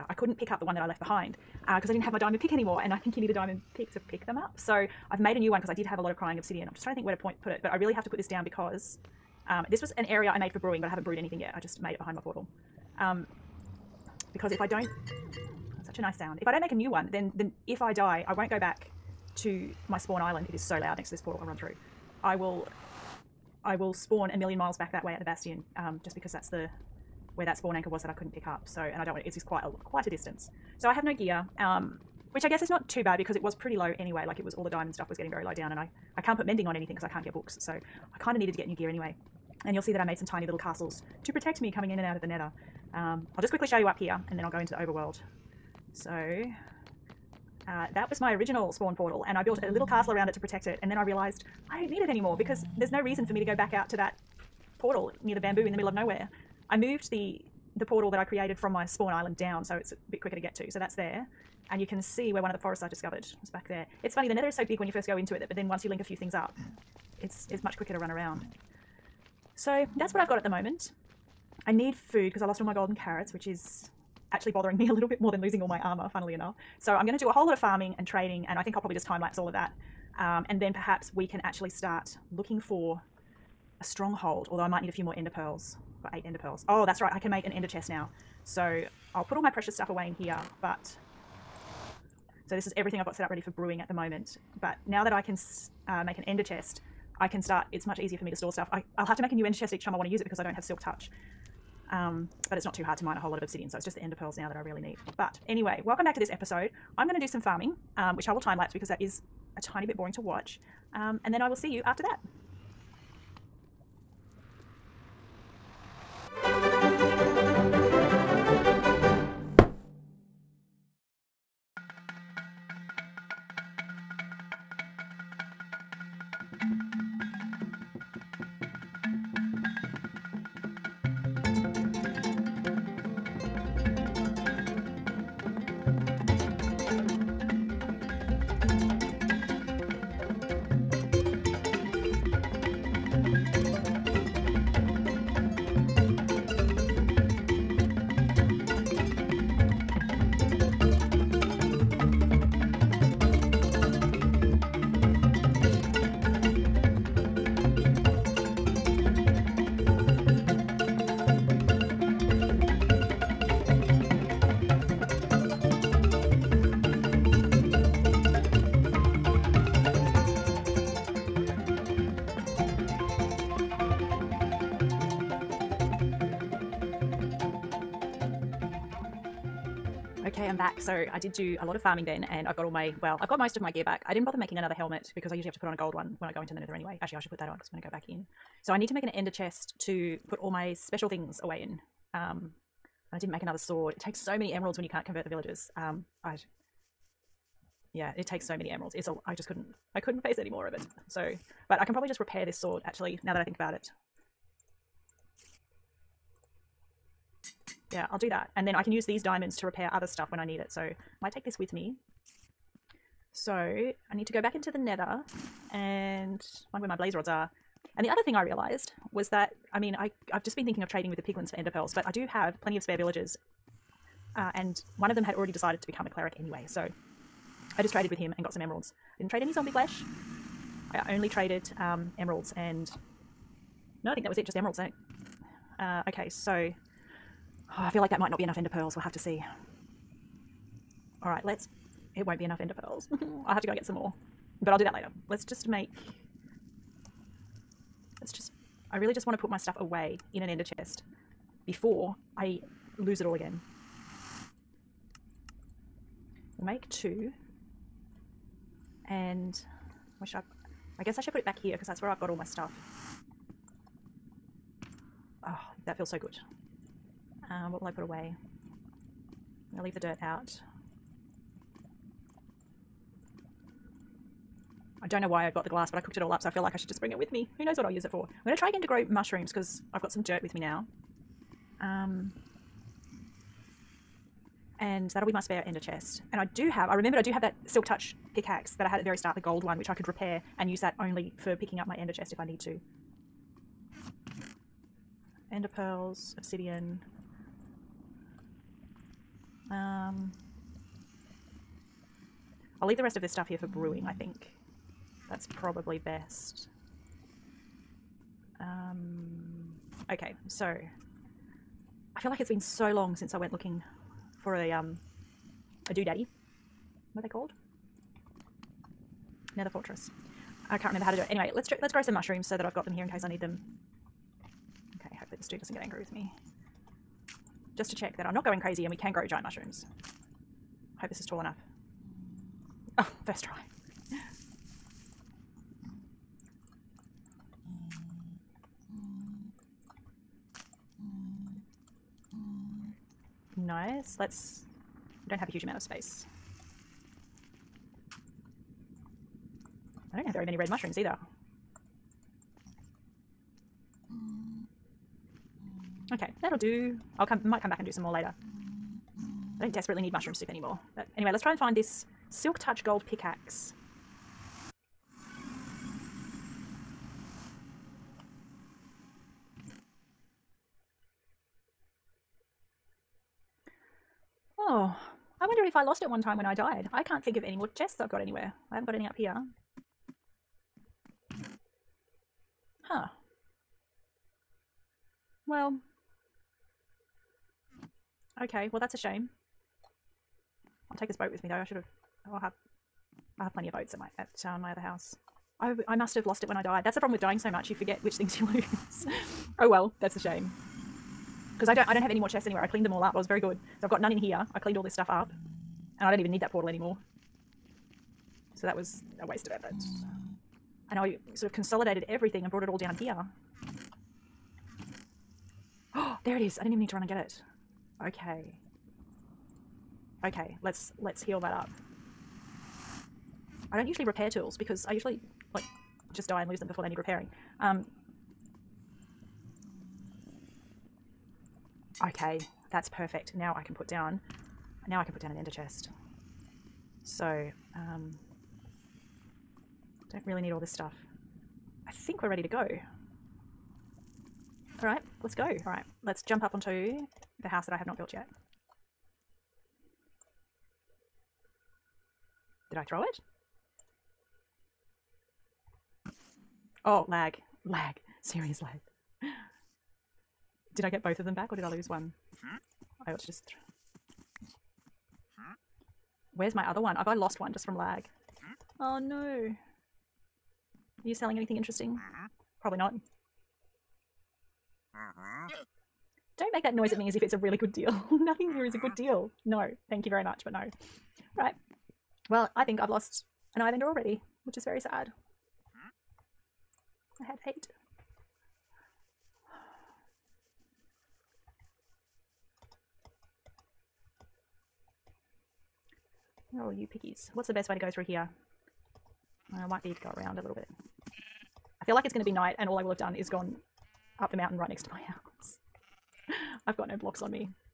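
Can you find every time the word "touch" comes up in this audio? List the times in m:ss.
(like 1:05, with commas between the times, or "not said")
1:40, 4:47, 6:02.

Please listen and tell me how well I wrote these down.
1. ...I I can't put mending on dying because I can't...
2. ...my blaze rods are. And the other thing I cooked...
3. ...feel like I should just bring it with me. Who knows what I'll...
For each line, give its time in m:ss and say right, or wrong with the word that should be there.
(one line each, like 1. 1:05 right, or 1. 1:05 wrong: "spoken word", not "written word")
1. 0:35 wrong: "anything", not "dying"
2. 3:36 wrong: "realized", not "cooked"
3. 4:36 right.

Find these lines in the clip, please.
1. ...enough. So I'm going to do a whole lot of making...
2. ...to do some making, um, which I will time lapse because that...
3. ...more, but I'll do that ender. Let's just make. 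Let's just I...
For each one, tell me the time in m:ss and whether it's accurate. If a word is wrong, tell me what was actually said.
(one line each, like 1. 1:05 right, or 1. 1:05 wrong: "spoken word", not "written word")
1. 1:16 wrong: "farming", not "making"
2. 1:47 wrong: "farming", not "making"
3. 4:03 wrong: "later", not "ender".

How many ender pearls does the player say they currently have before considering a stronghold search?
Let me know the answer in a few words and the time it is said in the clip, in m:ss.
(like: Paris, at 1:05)
8, at 1:26.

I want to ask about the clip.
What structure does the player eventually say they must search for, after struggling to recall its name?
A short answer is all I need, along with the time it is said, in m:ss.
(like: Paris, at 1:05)
Nether Fortress, at 5:19.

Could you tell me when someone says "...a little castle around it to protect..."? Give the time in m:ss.
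0:49.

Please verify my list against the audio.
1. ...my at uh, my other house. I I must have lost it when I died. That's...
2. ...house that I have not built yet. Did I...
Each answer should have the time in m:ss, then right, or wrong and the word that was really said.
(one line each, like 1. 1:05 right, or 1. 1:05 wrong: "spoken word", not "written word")
1. 6:33 right
2. 7:27 right.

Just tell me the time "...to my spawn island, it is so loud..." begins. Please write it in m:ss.
0:19.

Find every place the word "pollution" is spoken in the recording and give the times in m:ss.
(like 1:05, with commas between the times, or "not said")
not said.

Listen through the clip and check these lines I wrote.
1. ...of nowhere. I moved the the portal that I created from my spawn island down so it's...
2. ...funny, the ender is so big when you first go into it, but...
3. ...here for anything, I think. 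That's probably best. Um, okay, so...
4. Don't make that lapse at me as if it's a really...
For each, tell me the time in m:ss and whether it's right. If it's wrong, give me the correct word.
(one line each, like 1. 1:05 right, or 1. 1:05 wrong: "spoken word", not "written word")
1. 0:55 right
2. 1:04 wrong: "nether", not "ender"
3. 5:03 wrong: "brewing", not "anything"
4. 7:56 wrong: "noise", not "lapse".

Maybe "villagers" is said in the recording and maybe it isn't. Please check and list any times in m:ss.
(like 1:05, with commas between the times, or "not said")
3:15, 3:42.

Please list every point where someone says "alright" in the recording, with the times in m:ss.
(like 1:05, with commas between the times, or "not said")
not said.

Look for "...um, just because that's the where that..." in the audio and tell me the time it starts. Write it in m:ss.
0:25.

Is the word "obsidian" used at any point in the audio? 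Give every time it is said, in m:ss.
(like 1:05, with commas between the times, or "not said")
0:06, 1:43, 4:56.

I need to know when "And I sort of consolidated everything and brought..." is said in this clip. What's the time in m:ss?
6:50.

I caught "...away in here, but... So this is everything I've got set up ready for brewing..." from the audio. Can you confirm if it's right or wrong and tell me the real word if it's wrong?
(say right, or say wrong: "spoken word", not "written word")
right.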